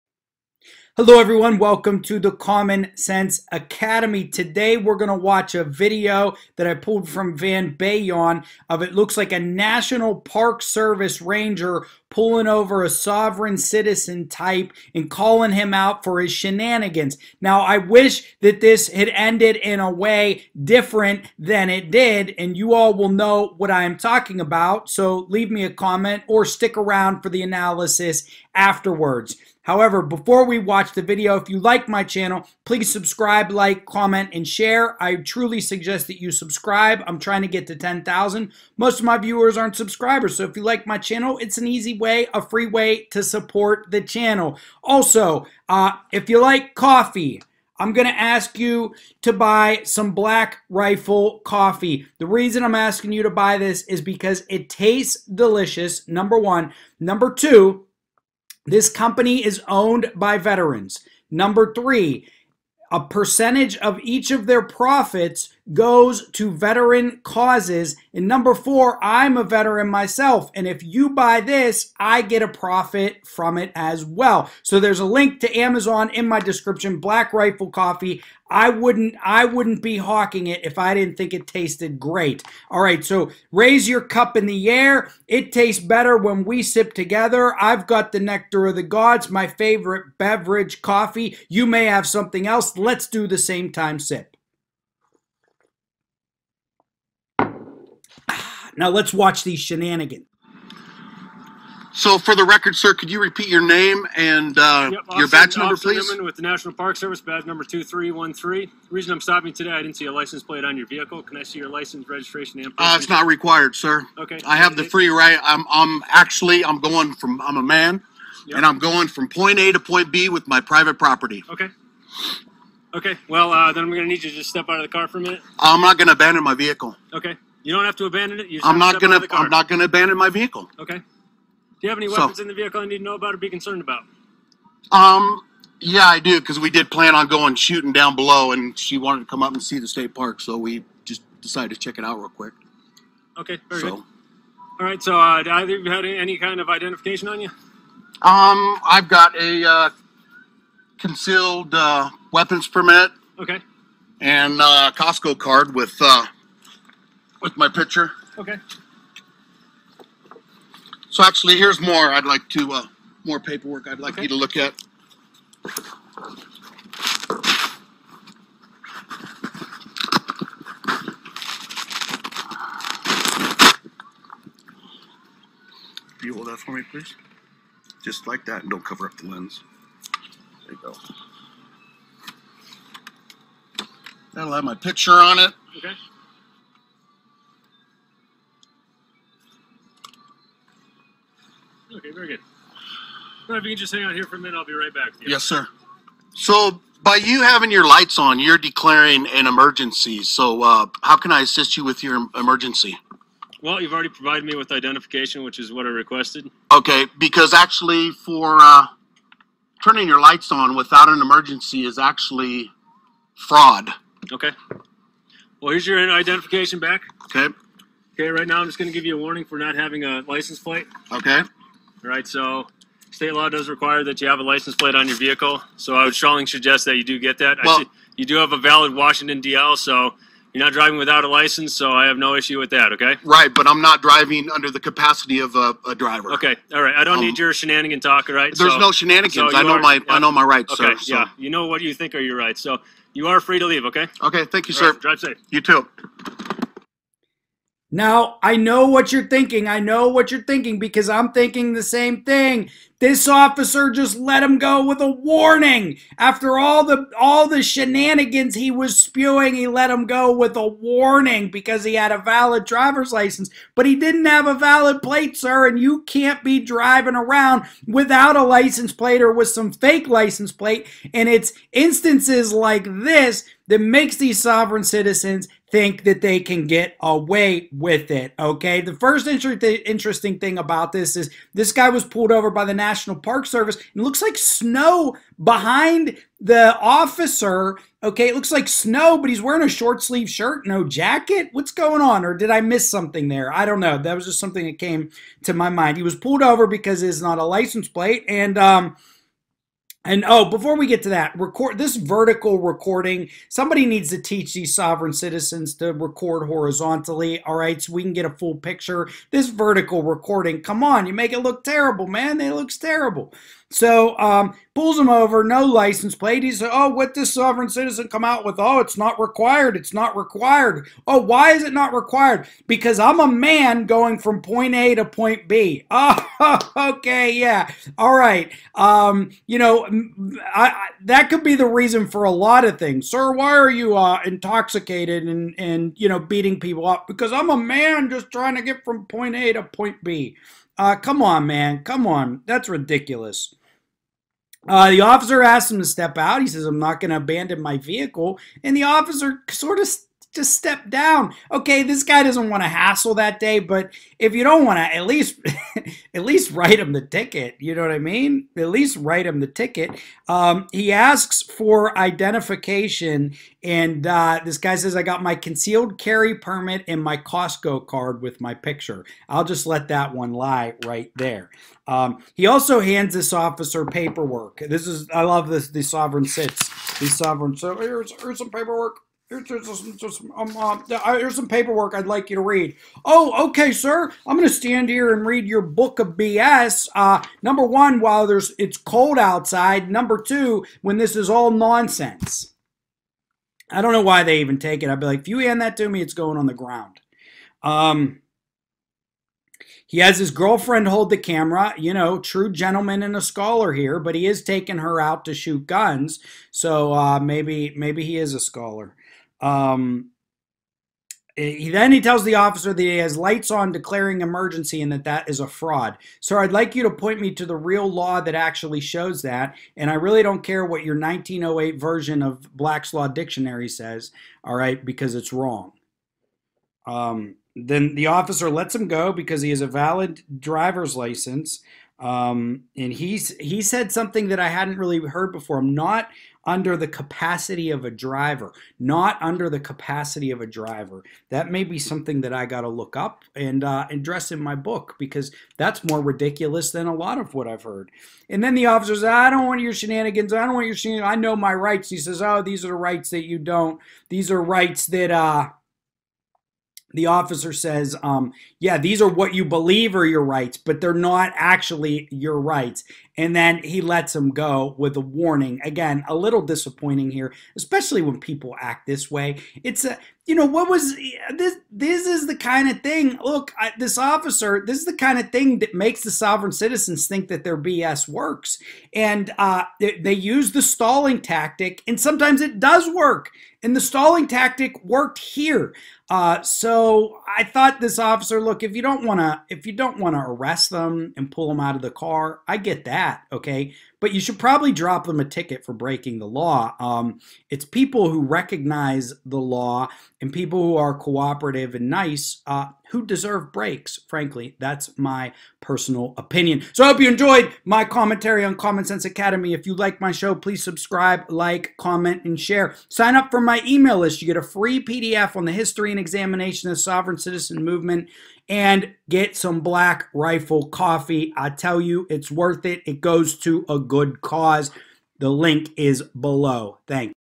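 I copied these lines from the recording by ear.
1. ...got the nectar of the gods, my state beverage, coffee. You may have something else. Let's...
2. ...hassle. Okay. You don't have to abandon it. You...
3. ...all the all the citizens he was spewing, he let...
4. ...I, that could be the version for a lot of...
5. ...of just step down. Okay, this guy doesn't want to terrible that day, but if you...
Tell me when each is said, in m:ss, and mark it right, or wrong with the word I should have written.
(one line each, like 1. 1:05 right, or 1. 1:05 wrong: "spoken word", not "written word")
1. 1:27 wrong: "favorite", not "state"
2. 2:06 wrong: "vehicle", not "hassle"
3. 4:16 wrong: "shenanigans", not "citizens"
4. 5:30 wrong: "reason", not "version"
5. 5:49 wrong: "hassle", not "terrible".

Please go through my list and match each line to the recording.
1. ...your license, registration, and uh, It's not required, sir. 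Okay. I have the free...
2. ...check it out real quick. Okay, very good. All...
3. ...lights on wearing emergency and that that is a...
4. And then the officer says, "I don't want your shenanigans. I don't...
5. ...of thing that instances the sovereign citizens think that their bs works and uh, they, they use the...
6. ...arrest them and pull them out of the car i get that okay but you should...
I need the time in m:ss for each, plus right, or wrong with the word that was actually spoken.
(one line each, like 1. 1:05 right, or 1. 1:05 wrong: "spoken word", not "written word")
1. 1:51 right
2. 2:21 right
3. 6:53 wrong: "declaring", not "wearing"
4. 7:28 right
5. 7:55 wrong: "makes", not "instances"
6. 8:10 right.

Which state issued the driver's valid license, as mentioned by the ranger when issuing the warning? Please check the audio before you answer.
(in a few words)
Washington.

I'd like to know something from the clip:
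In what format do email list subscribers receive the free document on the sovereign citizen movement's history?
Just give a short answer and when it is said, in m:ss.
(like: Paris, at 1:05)
PDF, at 8:34.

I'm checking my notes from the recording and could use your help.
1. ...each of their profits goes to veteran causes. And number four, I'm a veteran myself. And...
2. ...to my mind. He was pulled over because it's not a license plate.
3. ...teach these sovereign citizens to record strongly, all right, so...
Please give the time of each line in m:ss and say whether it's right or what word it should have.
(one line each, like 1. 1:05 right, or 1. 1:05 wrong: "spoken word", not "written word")
1. 1:04 right
2. 4:55 right
3. 5:04 wrong: "horizontally", not "strongly".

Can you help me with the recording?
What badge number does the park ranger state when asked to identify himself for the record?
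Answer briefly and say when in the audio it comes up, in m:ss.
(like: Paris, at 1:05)
2313, at 1:47.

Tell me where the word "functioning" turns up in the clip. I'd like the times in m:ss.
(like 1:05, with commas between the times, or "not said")
not said.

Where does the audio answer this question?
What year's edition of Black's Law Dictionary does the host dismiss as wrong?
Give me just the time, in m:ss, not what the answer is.
7:00.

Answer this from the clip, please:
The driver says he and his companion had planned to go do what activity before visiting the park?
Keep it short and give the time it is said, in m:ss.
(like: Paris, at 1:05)
shooting, at 2:17.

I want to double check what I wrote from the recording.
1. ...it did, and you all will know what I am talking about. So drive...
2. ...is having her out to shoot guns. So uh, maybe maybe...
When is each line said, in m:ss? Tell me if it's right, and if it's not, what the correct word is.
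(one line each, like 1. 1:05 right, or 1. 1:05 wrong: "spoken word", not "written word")
1. 0:21 wrong: "leave", not "drive"
2. 6:44 wrong: "taking", not "having".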